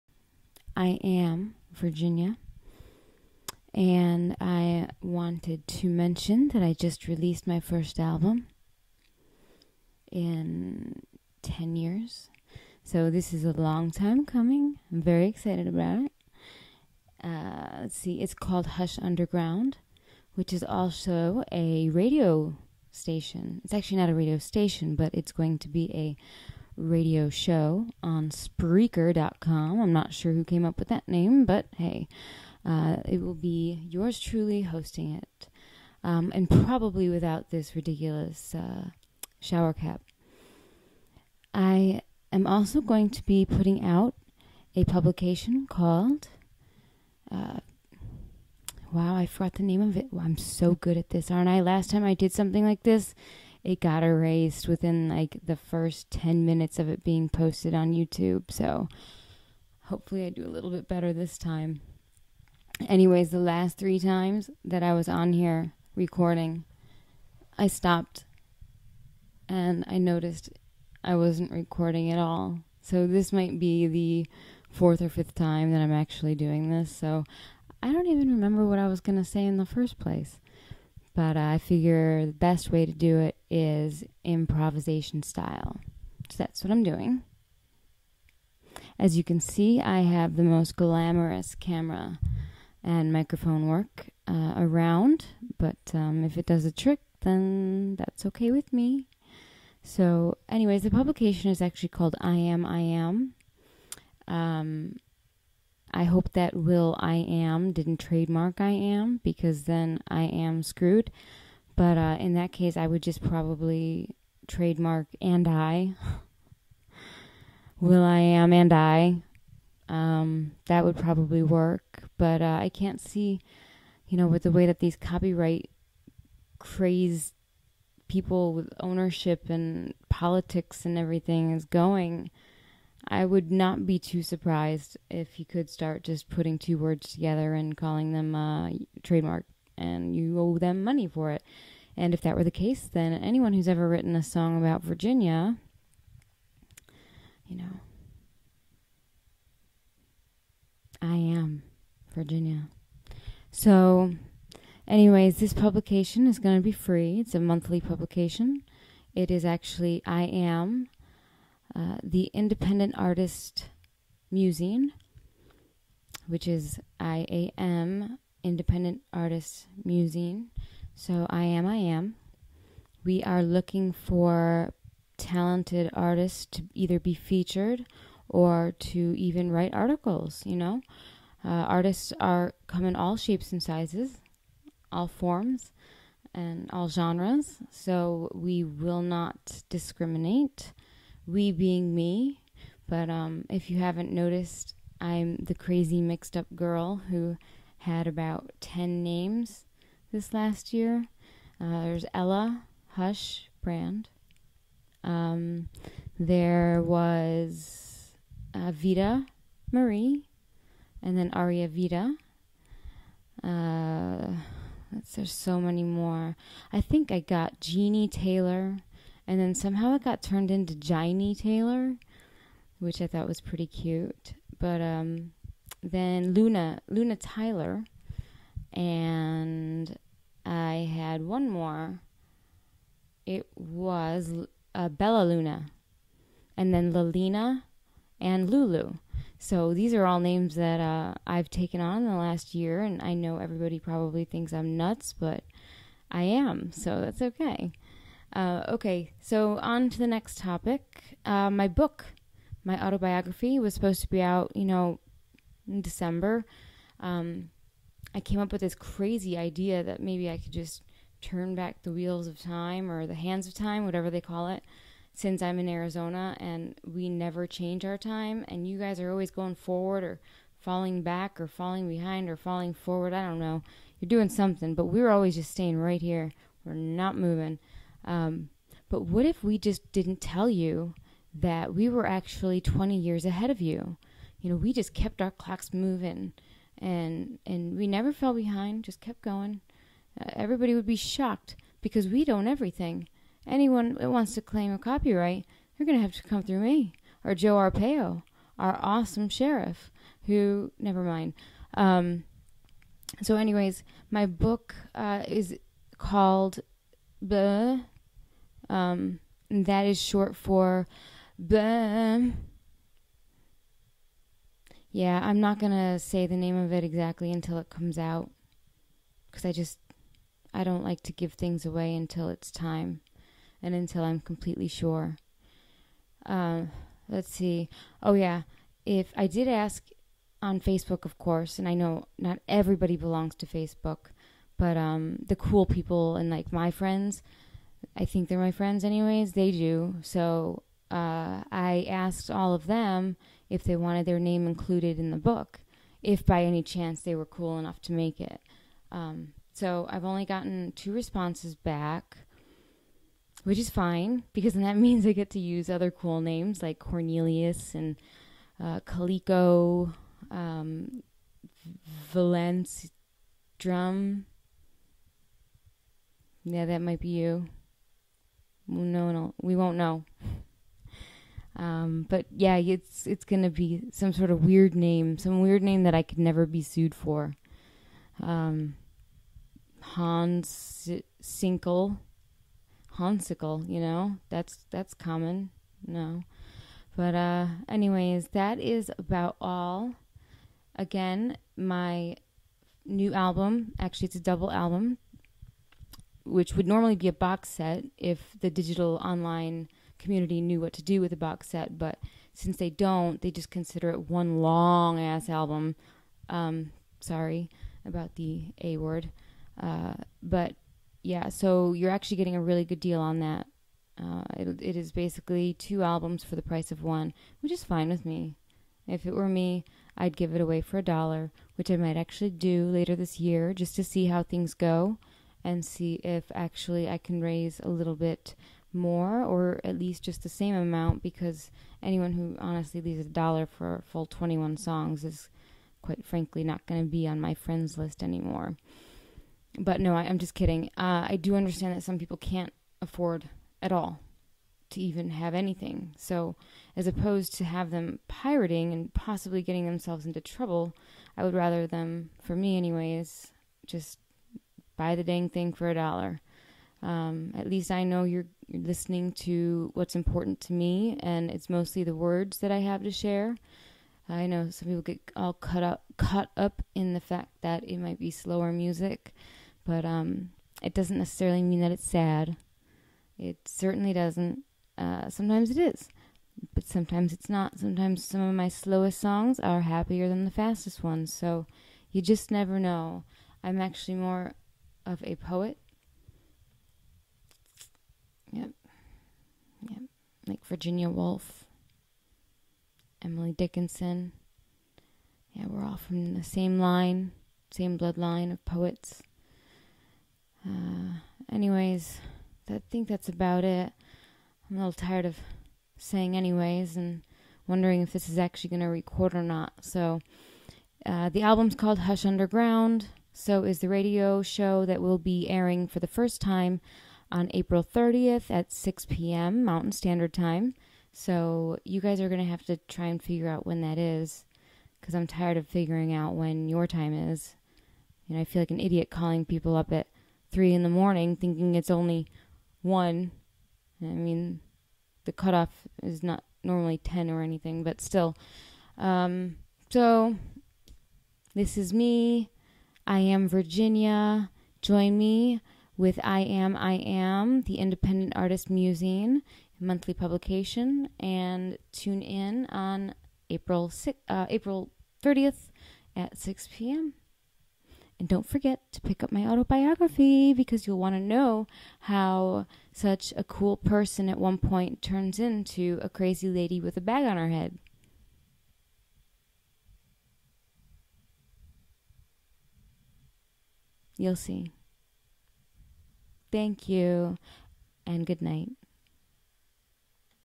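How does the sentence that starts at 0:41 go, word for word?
I am also going to be putting out a publication called.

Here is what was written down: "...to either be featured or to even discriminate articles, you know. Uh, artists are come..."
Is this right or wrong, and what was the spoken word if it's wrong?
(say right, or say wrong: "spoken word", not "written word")
wrong: "write", not "discriminate".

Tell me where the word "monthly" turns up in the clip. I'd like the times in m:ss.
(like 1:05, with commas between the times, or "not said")
2:37, 9:09.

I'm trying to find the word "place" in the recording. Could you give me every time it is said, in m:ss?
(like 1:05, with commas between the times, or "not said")
1:19.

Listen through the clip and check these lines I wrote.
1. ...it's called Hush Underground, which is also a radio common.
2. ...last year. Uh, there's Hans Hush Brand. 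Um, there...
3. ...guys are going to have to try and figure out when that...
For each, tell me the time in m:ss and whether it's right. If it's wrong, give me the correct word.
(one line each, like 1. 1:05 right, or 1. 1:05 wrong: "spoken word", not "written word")
1. 0:18 wrong: "station", not "common"
2. 3:20 wrong: "Ella", not "Hans"
3. 8:41 right.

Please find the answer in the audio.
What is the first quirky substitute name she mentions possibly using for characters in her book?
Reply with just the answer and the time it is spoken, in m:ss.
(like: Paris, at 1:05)
Cornelius, at 5:56.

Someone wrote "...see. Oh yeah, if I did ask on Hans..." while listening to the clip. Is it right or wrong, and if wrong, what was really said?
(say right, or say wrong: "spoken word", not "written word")
wrong: "Facebook", not "Hans".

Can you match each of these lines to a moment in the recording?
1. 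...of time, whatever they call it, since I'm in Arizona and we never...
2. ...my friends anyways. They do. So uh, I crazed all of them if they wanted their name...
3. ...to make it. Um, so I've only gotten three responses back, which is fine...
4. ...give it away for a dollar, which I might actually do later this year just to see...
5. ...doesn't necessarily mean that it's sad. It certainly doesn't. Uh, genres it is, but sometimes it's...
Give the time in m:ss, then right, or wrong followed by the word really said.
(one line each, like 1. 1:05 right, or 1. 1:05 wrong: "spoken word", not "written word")
1. 4:23 right
2. 5:38 wrong: "asked", not "crazed"
3. 5:47 wrong: "two", not "three"
4. 7:00 right
5. 7:50 wrong: "sometimes", not "genres".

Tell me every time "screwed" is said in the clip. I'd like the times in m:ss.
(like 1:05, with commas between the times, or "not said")
1:50.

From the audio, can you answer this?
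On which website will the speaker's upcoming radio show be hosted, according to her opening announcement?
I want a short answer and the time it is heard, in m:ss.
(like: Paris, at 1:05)
Spreaker.com, at 0:28.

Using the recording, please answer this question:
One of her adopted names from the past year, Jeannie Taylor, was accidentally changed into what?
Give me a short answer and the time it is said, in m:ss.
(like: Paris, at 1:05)
Jiny Taylor, at 3:40.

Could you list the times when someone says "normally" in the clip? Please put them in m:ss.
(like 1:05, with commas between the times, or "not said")
6:36, 8:56.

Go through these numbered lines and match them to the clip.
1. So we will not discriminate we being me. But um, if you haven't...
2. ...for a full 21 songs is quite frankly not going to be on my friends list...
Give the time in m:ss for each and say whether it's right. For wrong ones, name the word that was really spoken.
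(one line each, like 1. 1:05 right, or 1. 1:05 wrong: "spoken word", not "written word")
1. 3:07 right
2. 7:13 right.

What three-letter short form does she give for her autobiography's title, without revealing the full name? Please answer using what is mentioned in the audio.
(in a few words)
BAM.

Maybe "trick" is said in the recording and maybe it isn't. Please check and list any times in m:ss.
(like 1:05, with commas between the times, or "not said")
1:36.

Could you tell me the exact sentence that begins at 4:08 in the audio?
Uh, okay, so on to the next topic.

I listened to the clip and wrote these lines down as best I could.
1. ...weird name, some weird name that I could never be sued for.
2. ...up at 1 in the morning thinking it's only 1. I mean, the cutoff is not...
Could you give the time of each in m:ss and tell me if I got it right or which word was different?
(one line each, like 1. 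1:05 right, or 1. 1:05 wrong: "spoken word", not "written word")
1. 6:14 right
2. 8:49 wrong: "3", not "1".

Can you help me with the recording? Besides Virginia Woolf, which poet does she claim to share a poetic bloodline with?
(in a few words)
Emily Dickinson.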